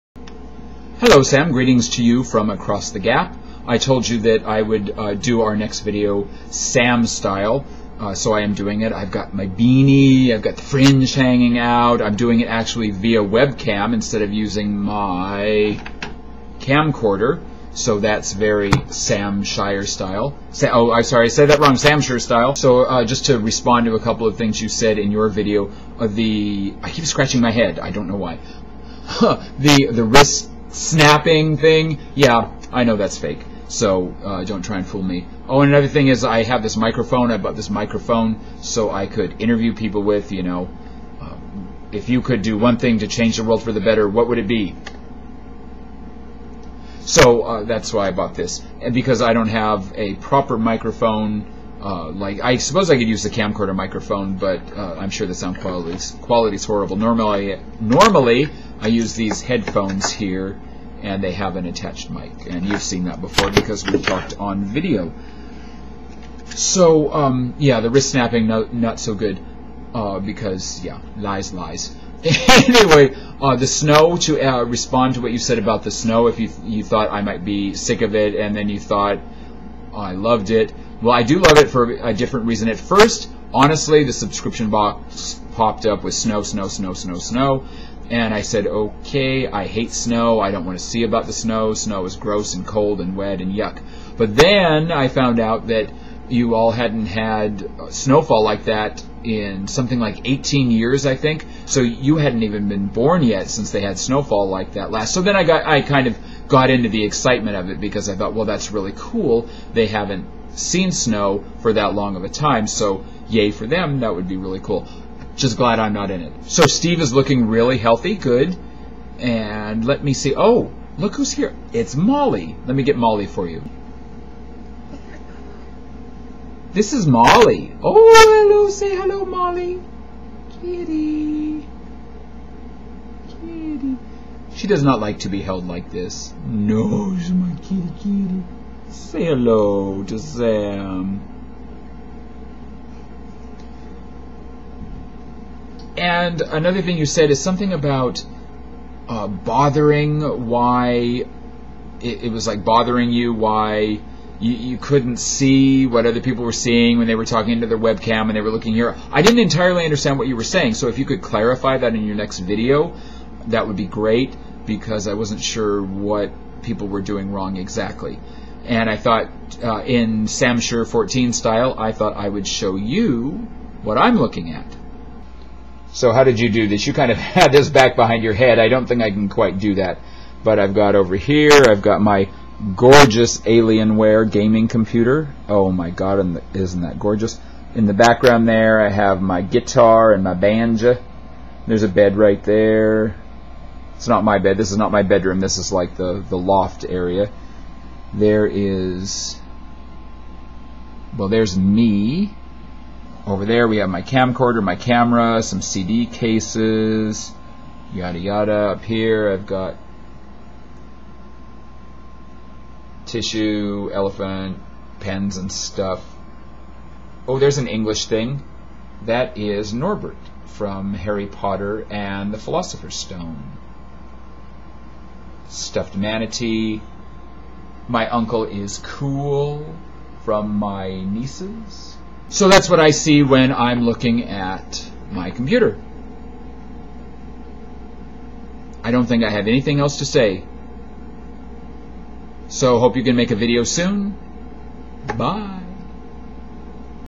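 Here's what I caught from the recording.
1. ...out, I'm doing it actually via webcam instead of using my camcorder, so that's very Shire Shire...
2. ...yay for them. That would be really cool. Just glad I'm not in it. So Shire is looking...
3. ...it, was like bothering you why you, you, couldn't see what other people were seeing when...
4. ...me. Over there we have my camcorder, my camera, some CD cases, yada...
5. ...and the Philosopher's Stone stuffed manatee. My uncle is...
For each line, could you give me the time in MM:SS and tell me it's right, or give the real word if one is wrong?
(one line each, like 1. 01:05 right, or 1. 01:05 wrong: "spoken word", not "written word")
1. 00:11 wrong: "Sam", not "Shire"
2. 01:53 wrong: "Steve", not "Shire"
3. 02:32 right
4. 03:21 right
5. 03:41 right.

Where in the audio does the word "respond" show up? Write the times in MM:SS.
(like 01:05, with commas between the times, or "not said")
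00:23, 01:14.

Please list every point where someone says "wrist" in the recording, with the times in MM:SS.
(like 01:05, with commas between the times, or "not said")
00:30, 01:07.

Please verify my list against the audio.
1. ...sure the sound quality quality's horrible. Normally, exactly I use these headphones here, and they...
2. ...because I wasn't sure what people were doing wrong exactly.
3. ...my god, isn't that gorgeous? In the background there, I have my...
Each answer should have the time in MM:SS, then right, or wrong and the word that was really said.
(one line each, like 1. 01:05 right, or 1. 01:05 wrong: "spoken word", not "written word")
1. 00:55 wrong: "normally", not "exactly"
2. 02:44 right
3. 03:05 right.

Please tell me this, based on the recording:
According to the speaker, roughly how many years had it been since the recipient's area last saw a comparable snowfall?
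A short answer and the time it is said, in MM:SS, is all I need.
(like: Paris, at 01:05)
18, at 01:40.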